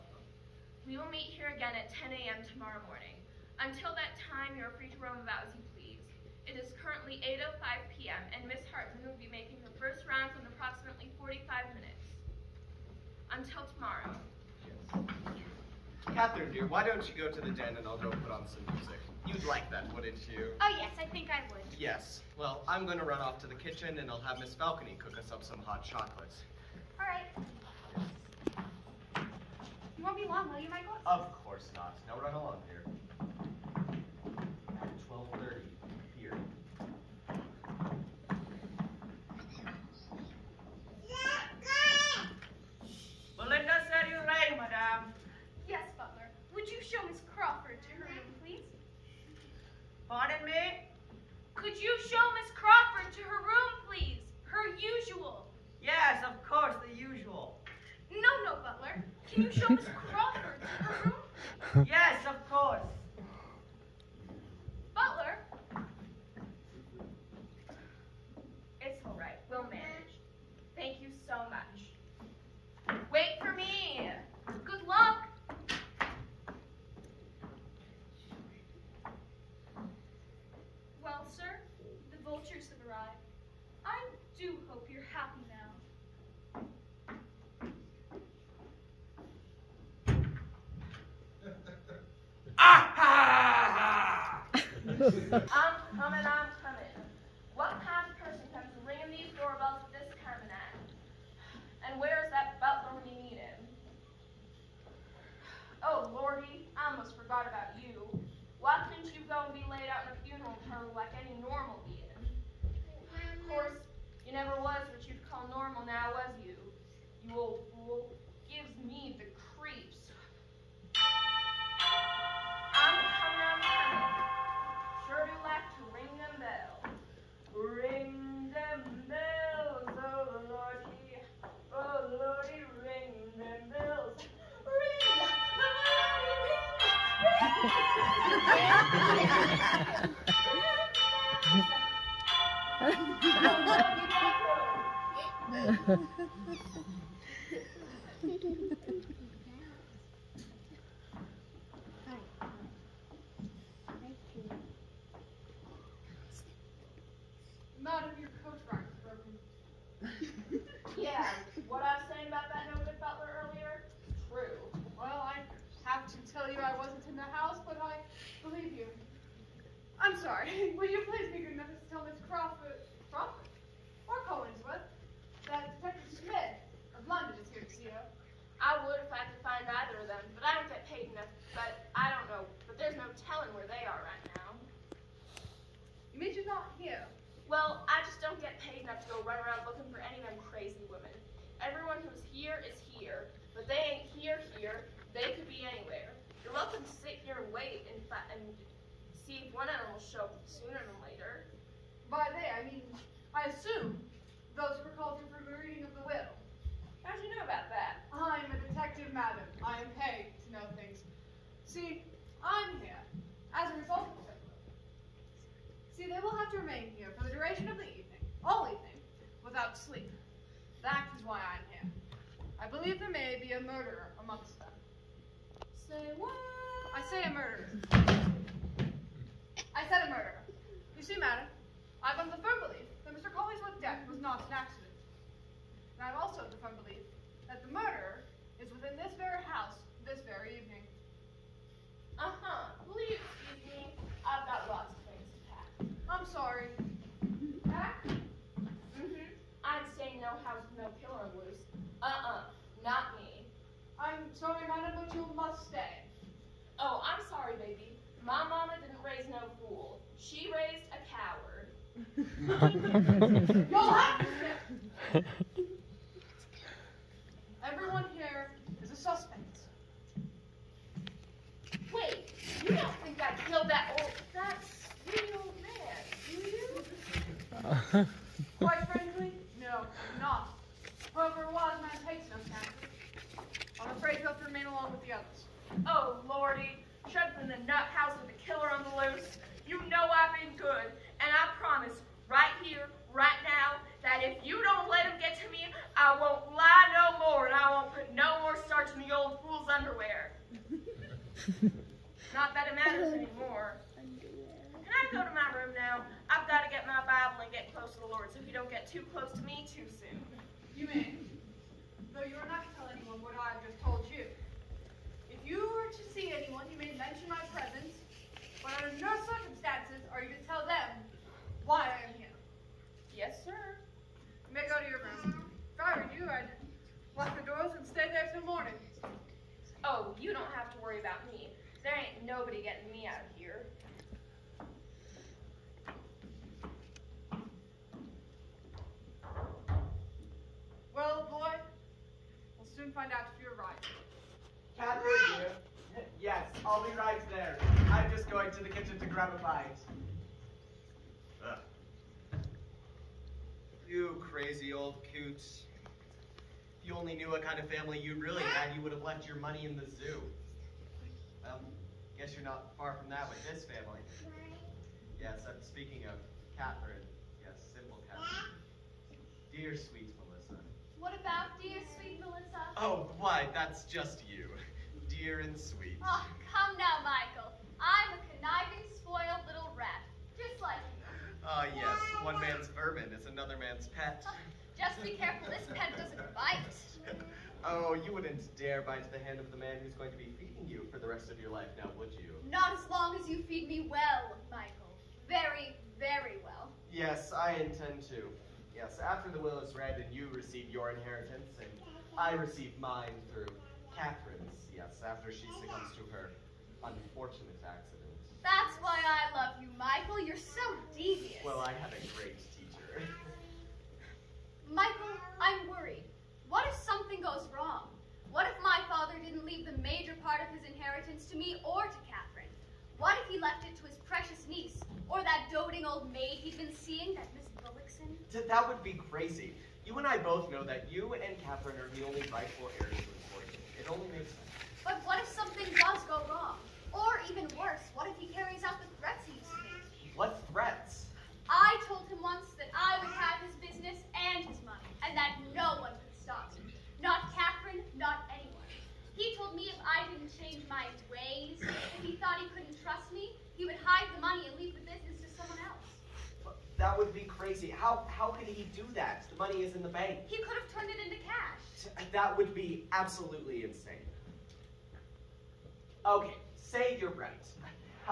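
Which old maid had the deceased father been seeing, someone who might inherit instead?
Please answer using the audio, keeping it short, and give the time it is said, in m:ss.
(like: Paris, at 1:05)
Miss Bullockson, at 7:07.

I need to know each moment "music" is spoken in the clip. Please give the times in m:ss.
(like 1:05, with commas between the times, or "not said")
0:18.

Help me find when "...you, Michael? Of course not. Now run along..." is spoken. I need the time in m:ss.
0:30.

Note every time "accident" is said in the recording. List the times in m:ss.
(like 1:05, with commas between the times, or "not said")
3:54, 6:47.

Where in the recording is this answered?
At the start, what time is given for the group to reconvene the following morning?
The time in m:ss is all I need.
0:01.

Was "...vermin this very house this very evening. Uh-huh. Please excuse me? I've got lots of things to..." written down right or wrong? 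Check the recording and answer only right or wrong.
wrong.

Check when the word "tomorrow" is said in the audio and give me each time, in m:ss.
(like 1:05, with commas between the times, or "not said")
0:02, 0:13.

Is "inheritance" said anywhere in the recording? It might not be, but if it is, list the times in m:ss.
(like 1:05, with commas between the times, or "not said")
6:40, 7:00.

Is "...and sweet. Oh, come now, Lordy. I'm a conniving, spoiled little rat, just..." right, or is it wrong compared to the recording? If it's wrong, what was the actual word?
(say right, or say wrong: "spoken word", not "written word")
wrong: "Michael", not "Lordy".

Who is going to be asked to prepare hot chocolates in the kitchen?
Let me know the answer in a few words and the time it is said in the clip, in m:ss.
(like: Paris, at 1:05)
Miss Falcony, at 0:24.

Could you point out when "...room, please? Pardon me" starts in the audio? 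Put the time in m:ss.
0:48.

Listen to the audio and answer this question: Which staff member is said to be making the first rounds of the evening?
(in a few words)
Miss Hartman.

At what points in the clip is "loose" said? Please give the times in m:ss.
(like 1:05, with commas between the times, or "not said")
4:11, 4:49.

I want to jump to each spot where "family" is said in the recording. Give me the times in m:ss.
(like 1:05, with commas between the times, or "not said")
5:57, 6:03.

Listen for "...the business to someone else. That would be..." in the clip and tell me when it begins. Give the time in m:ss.
7:34.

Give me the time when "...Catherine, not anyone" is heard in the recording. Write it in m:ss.
7:27.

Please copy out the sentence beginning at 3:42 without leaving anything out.
I believe there may be a murderer amongst Say what?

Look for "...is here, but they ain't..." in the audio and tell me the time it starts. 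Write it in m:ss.
3:12.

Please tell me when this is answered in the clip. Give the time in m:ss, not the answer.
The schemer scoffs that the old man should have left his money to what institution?
5:59.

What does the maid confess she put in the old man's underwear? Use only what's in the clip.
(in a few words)
starch.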